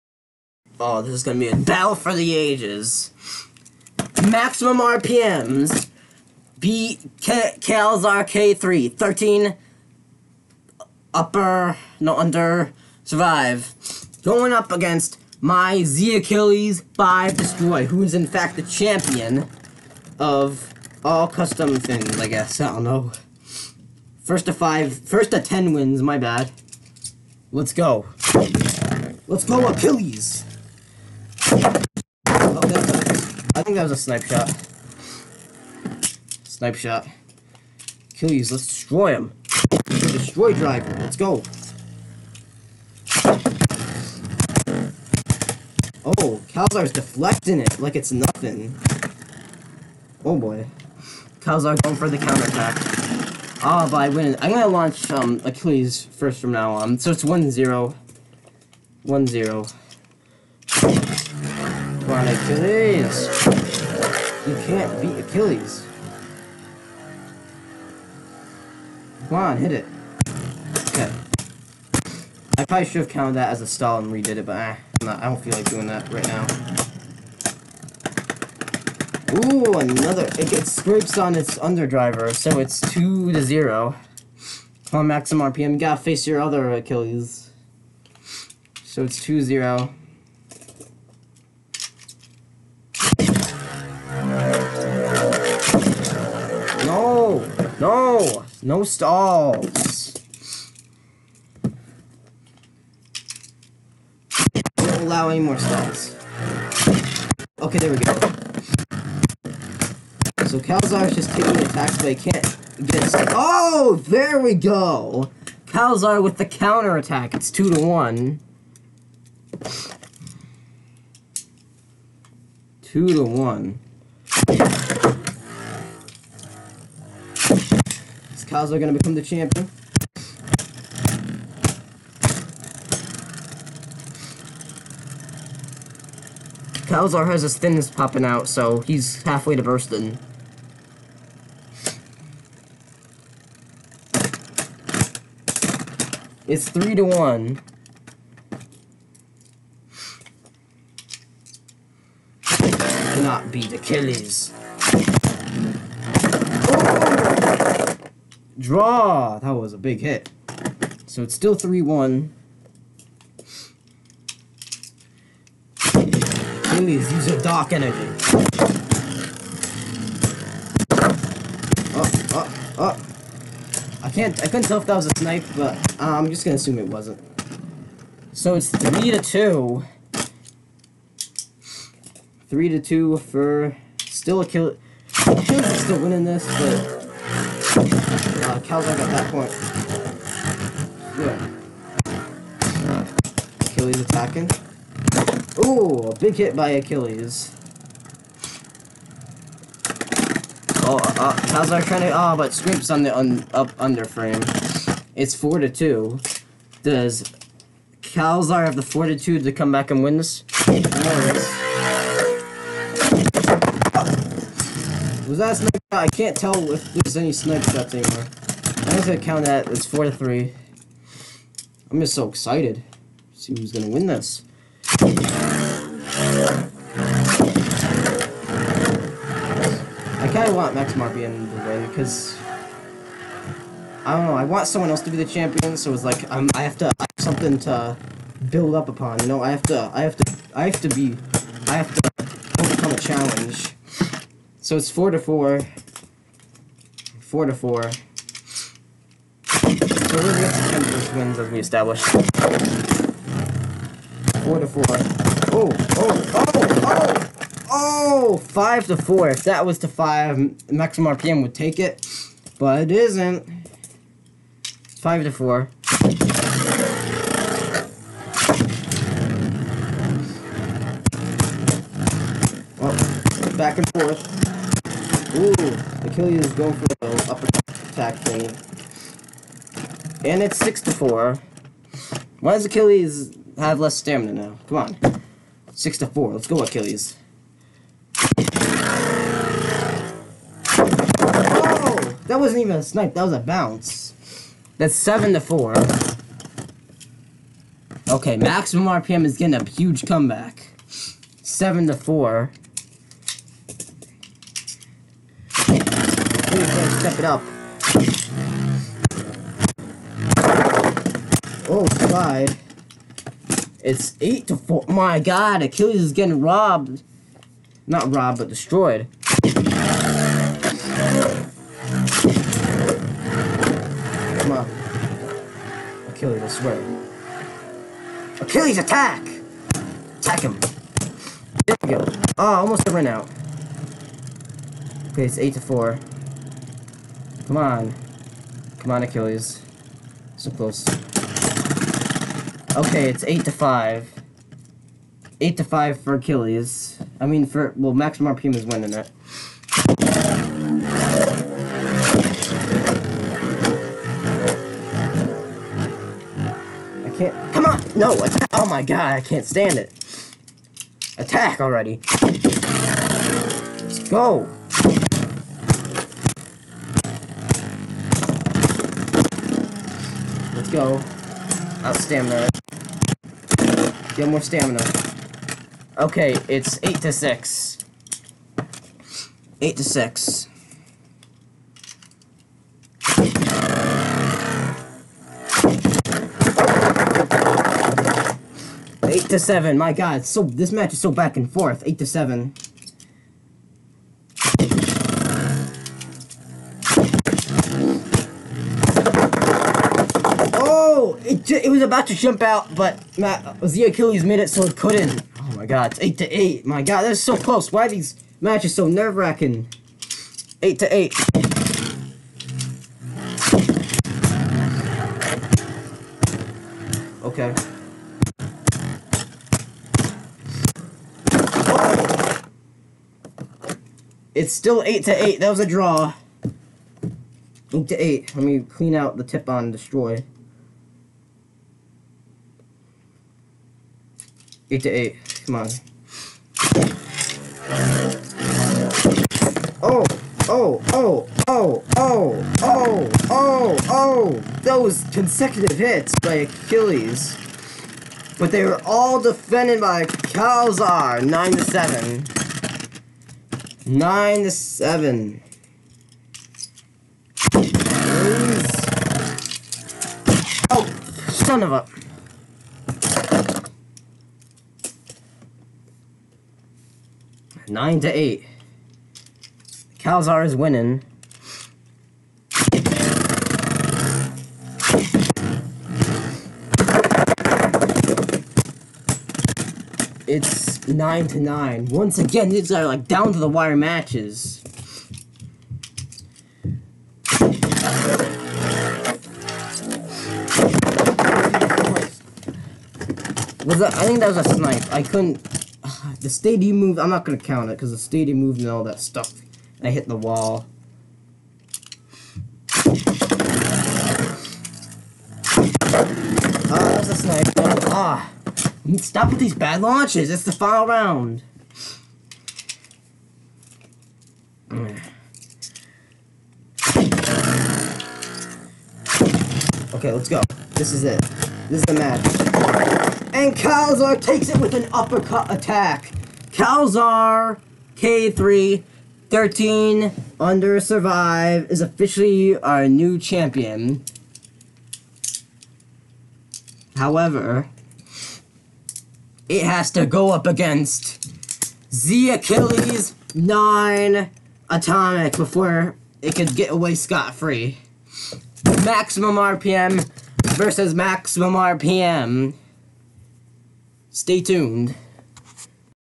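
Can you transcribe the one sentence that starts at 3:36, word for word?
I can't tell if there's any snipe shots anymore.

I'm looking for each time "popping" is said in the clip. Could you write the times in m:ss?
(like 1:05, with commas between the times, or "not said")
2:17.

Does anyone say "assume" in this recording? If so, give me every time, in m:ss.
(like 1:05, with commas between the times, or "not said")
2:56.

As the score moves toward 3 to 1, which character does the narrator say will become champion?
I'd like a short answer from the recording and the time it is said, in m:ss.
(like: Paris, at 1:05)
Kazuya, at 2:08.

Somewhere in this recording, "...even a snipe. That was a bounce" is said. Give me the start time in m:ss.
4:52.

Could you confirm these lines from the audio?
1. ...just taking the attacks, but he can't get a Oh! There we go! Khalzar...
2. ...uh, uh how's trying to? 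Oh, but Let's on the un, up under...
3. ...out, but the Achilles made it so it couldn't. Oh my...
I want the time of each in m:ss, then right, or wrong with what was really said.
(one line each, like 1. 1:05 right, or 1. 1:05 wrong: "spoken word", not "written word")
1. 1:51 right
2. 3:20 wrong: "Scrimp", not "Let"
3. 6:42 right.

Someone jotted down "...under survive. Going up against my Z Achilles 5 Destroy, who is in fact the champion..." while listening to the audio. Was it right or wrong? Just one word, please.
right.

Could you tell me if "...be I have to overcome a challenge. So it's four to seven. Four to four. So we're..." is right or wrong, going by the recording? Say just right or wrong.
wrong.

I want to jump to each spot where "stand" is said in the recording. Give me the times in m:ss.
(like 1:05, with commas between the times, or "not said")
5:59, 6:11.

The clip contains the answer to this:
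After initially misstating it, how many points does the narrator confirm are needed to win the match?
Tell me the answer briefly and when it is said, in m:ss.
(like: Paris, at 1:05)
10, at 0:24.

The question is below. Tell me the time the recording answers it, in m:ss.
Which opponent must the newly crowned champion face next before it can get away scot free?
9:01.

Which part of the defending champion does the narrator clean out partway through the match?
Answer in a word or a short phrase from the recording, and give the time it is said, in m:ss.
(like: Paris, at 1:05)
the tip on Destroy, at 7:09.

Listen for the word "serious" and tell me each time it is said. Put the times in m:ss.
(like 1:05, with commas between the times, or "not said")
not said.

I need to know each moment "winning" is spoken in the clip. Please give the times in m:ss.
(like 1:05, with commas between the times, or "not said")
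3:06, 5:48, 7:50.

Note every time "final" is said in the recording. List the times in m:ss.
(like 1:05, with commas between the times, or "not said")
8:30.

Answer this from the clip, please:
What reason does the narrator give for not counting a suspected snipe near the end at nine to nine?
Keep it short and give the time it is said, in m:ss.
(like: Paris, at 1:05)
the stadium moved, at 8:17.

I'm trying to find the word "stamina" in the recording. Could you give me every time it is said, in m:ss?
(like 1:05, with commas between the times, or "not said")
4:43, 6:14.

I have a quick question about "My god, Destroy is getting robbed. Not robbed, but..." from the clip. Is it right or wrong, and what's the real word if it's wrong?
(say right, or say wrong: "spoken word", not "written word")
wrong: "Achilles", not "Destroy".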